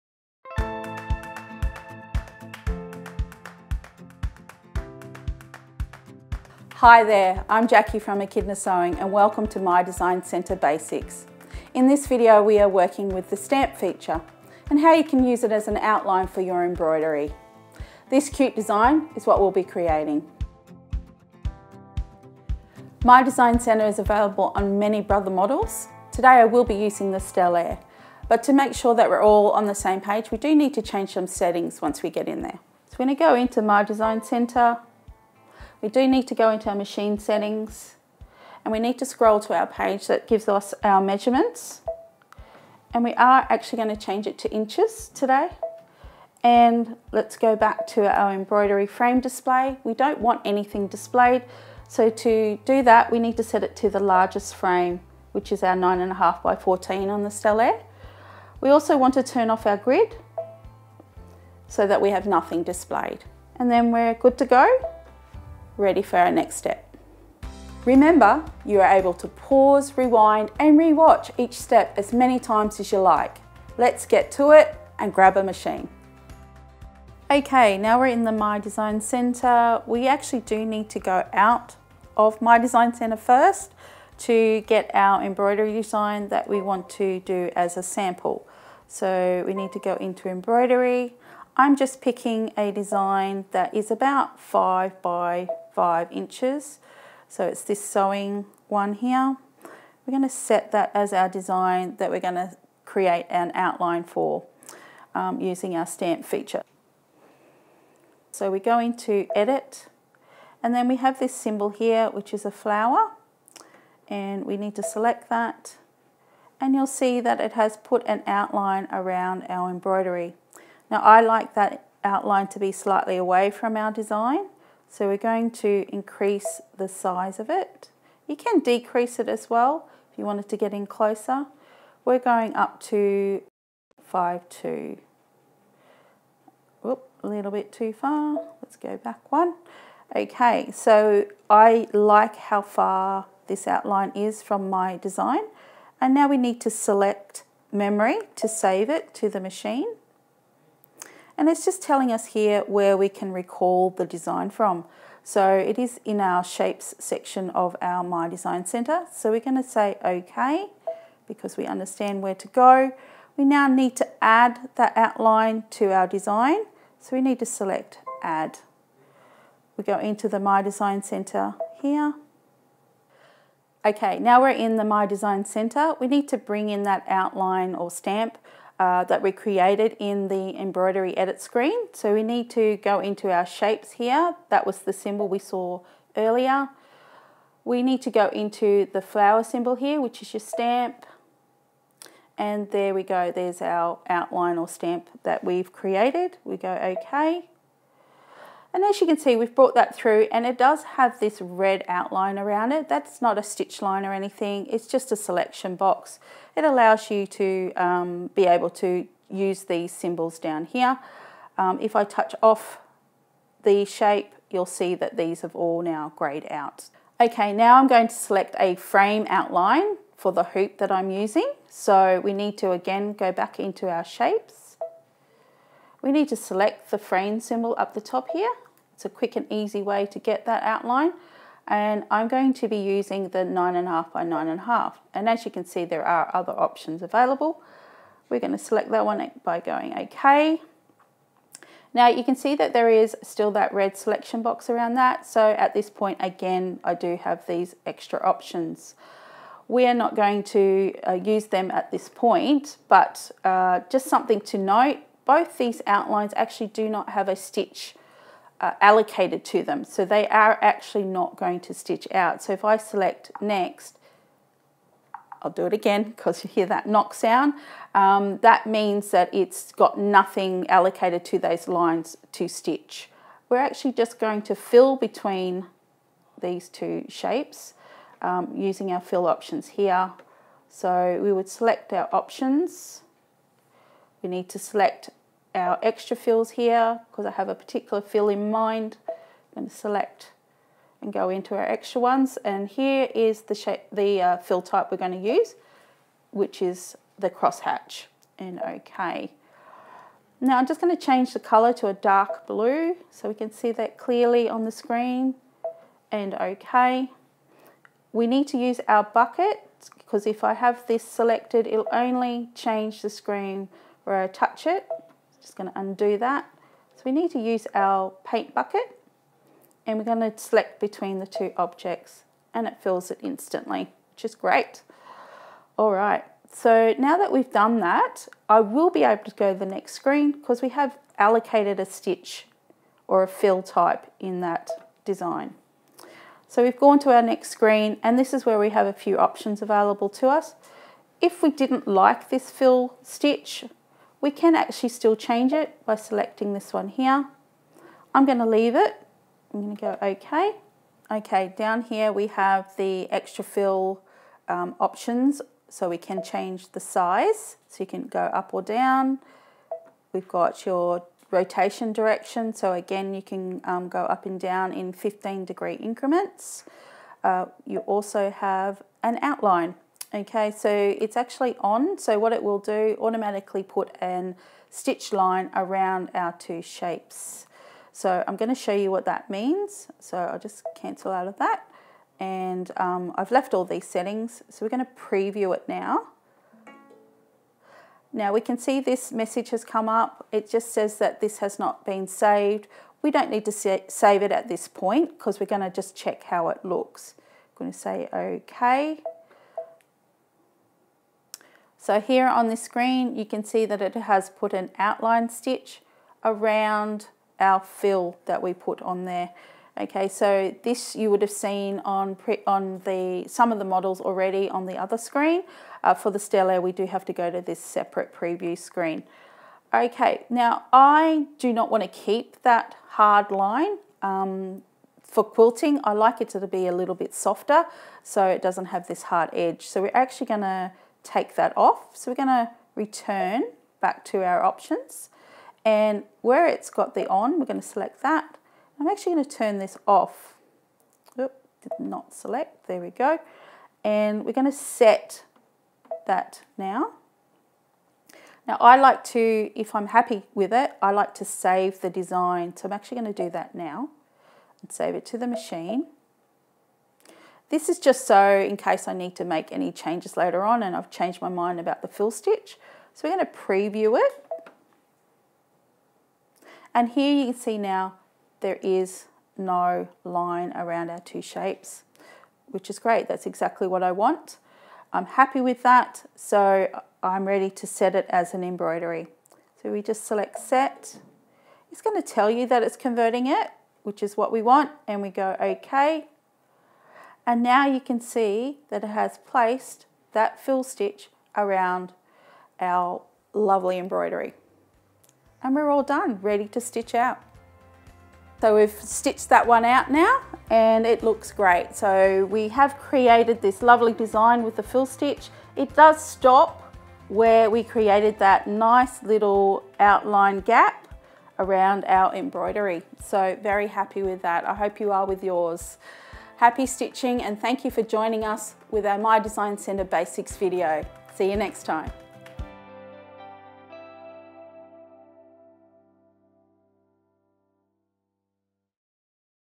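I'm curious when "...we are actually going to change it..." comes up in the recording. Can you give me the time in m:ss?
0:43.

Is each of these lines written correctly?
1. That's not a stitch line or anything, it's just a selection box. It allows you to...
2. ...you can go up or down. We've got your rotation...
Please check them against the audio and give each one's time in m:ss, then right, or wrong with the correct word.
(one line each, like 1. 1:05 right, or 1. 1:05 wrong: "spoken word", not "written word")
1. 3:22 right
2. 5:57 right.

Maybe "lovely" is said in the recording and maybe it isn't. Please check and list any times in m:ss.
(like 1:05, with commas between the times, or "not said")
8:13, 8:23.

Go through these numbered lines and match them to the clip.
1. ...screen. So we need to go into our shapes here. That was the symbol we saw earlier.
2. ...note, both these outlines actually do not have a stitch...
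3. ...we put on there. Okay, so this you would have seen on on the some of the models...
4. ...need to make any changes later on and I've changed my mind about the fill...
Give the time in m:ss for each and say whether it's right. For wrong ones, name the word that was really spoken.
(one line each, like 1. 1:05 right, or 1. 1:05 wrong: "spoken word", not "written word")
1. 3:01 right
2. 4:14 right
3. 6:48 right
4. 7:38 right.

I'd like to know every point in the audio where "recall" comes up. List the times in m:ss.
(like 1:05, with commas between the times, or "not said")
2:33.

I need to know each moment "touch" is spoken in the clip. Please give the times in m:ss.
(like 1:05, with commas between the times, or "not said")
3:32, 5:14.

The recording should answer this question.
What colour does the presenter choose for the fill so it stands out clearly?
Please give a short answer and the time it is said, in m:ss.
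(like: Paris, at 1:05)
dark blue, at 5:01.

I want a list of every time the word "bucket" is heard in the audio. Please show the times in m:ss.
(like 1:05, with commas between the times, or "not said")
5:09, 5:18.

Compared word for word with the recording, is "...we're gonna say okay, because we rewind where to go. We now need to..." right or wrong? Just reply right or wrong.
wrong.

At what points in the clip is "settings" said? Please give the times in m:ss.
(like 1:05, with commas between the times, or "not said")
0:31, 0:37, 6:23.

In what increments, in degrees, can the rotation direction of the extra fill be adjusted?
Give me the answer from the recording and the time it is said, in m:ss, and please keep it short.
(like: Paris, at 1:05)
15, at 6:04.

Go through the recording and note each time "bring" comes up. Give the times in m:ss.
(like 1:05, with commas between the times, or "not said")
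2:56.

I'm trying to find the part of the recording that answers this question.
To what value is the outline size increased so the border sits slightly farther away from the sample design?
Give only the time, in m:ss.
2:14.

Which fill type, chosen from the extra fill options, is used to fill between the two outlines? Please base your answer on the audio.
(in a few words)
crosshatch.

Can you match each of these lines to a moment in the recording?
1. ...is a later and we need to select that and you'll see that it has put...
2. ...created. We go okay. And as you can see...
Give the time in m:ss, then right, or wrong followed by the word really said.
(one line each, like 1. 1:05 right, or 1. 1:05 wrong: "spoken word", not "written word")
1. 1:52 wrong: "flower", not "later"
2. 3:15 right.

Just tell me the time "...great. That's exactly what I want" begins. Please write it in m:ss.
7:52.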